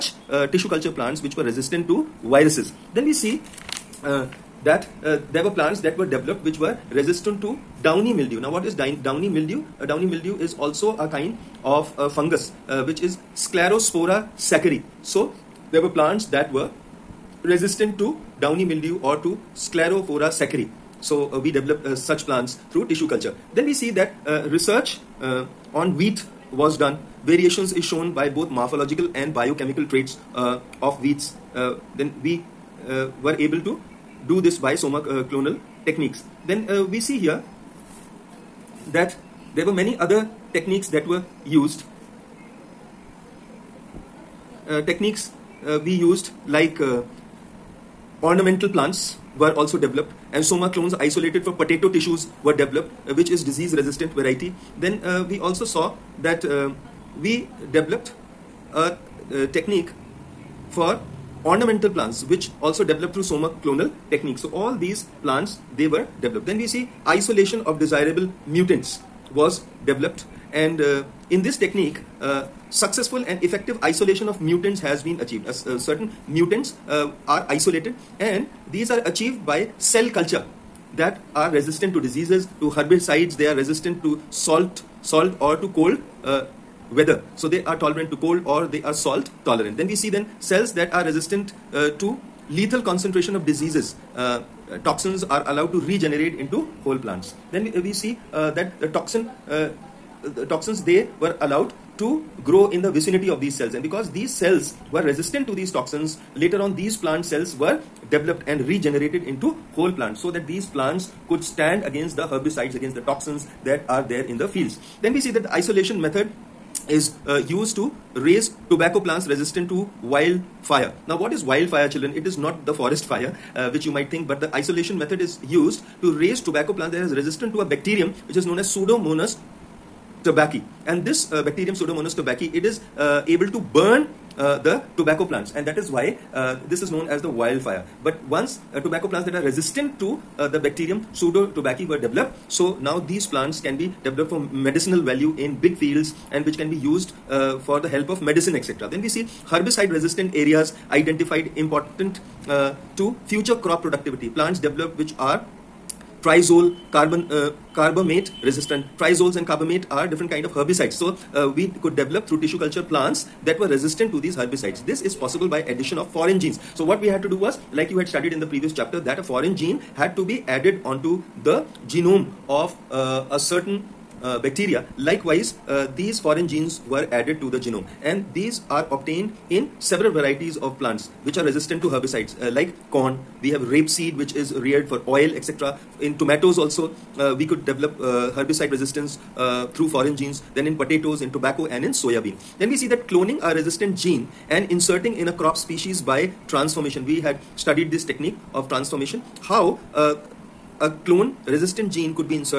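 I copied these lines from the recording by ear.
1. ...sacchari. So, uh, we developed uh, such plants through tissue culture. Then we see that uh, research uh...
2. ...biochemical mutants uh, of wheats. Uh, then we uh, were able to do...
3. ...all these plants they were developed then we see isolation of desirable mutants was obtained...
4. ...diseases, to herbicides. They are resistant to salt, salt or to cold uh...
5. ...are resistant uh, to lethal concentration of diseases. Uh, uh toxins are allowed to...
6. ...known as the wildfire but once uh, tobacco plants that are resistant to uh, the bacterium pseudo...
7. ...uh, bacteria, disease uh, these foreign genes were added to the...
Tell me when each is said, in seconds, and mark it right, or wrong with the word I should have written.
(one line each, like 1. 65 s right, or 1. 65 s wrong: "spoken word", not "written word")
1. 20 s right
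2. 29 s wrong: "traits", not "mutants"
3. 64 s wrong: "developed", not "obtained"
4. 82 s right
5. 90 s right
6. 136 s right
7. 174 s wrong: "likewise", not "disease".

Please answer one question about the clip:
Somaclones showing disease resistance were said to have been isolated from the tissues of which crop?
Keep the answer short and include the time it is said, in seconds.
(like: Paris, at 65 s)
Potato, at 51 s.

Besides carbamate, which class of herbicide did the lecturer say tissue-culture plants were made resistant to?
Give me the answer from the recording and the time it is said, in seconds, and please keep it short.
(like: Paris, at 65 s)
Triazole, at 156 s.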